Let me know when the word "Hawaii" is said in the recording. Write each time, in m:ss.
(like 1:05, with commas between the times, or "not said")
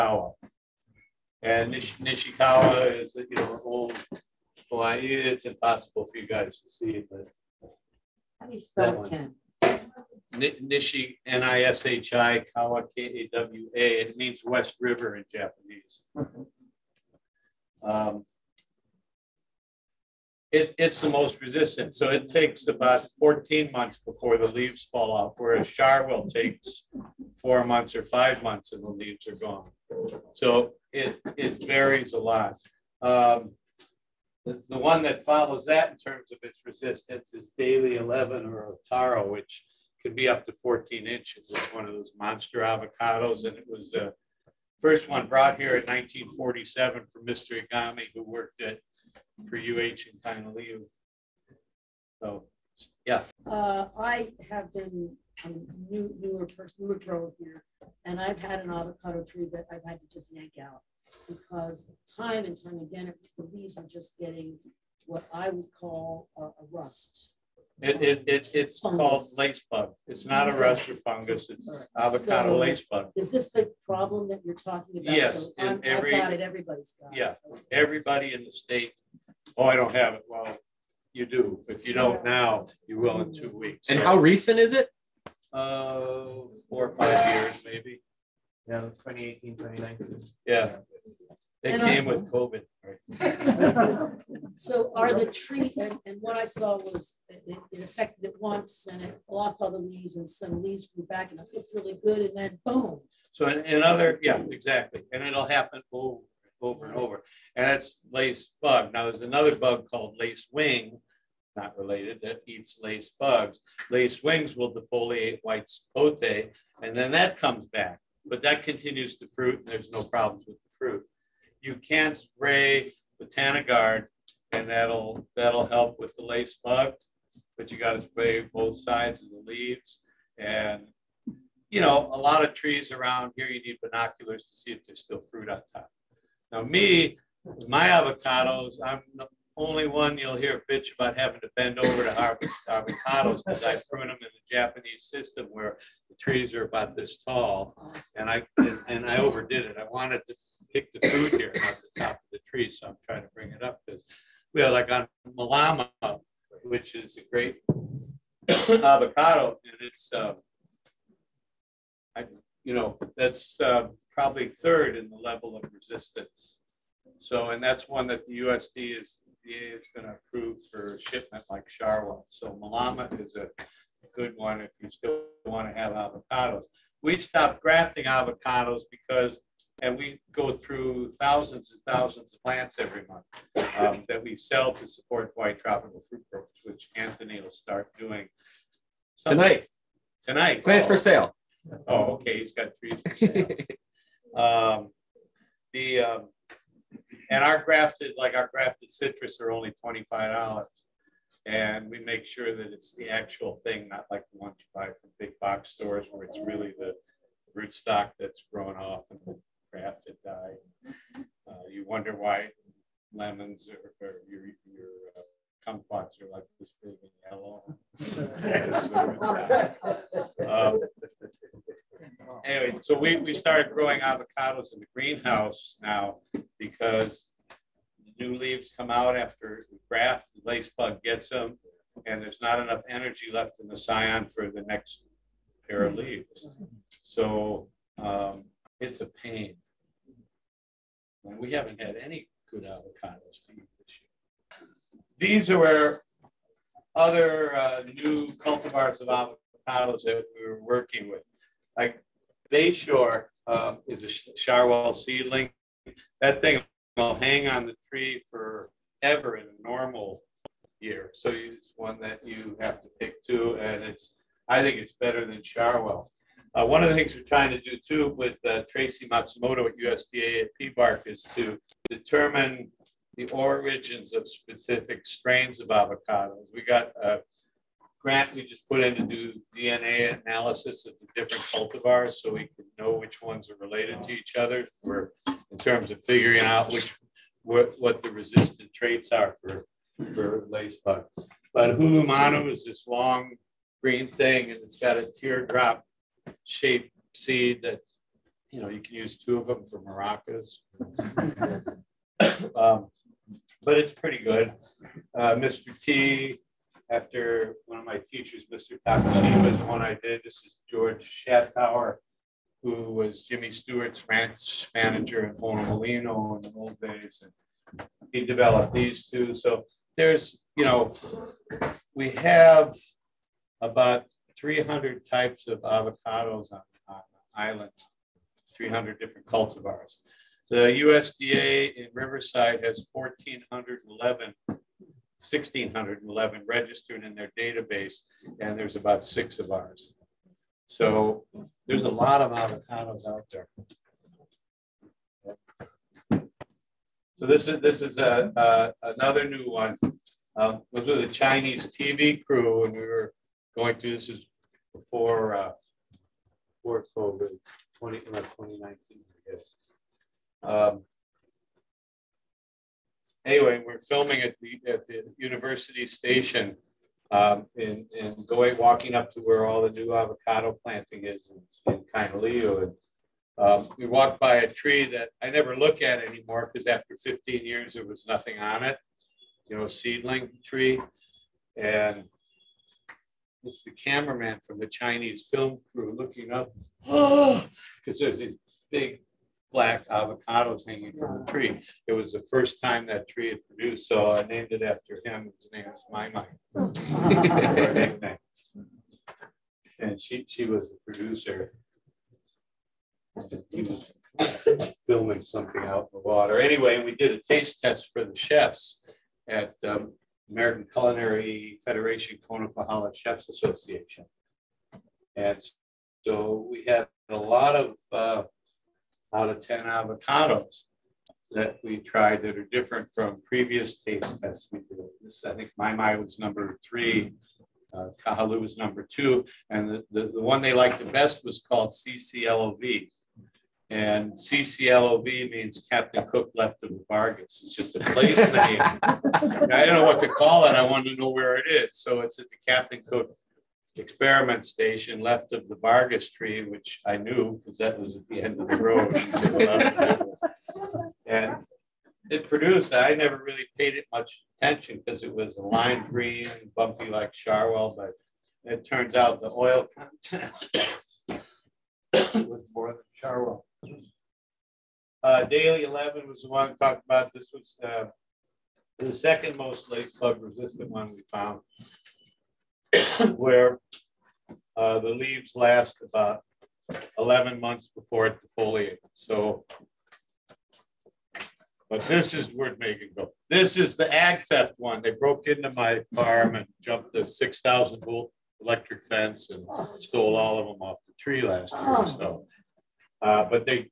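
0:04, 3:05.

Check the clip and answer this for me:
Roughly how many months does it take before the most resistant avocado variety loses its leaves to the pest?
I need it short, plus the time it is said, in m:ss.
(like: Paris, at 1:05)
14 months, at 0:23.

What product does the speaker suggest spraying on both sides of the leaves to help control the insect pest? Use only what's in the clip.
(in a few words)
Botanigard.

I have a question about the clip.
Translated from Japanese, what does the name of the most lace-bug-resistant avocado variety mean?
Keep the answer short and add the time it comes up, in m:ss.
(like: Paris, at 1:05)
West River, at 0:14.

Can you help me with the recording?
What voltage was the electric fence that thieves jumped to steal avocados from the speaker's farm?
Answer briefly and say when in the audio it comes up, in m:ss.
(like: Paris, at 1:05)
6,000 volts, at 8:07.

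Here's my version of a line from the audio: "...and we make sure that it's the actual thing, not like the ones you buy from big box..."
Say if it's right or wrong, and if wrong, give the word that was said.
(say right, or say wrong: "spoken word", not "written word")
right.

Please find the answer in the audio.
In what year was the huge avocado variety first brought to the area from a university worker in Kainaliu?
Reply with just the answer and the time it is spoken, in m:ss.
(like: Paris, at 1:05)
1947, at 0:45.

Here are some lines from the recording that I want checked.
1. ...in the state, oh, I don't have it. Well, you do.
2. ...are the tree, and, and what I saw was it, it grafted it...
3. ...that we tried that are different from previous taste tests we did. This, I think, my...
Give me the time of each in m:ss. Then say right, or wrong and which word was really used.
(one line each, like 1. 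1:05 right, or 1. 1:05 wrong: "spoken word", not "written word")
1. 1:18 right
2. 1:34 wrong: "affected", not "grafted"
3. 7:01 right.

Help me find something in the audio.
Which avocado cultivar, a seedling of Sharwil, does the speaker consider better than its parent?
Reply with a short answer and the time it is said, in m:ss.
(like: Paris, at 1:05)
Bayshore, at 4:12.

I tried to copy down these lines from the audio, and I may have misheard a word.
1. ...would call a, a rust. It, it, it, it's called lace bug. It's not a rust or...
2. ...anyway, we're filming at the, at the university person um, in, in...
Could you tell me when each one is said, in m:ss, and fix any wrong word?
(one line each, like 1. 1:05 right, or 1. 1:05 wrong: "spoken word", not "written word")
1. 1:05 right
2. 6:03 wrong: "station", not "person".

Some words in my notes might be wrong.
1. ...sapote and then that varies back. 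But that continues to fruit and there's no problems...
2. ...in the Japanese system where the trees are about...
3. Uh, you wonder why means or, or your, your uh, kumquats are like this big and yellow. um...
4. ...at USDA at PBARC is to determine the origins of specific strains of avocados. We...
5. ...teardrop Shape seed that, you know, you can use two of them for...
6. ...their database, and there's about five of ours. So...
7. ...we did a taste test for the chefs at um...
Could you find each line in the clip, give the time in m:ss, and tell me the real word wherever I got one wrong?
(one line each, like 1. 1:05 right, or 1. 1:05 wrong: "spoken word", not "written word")
1. 1:55 wrong: "comes", not "varies"
2. 2:24 right
3. 3:31 wrong: "lemons", not "means"
4. 4:29 right
5. 4:55 right
6. 5:37 wrong: "six", not "five"
7. 6:46 right.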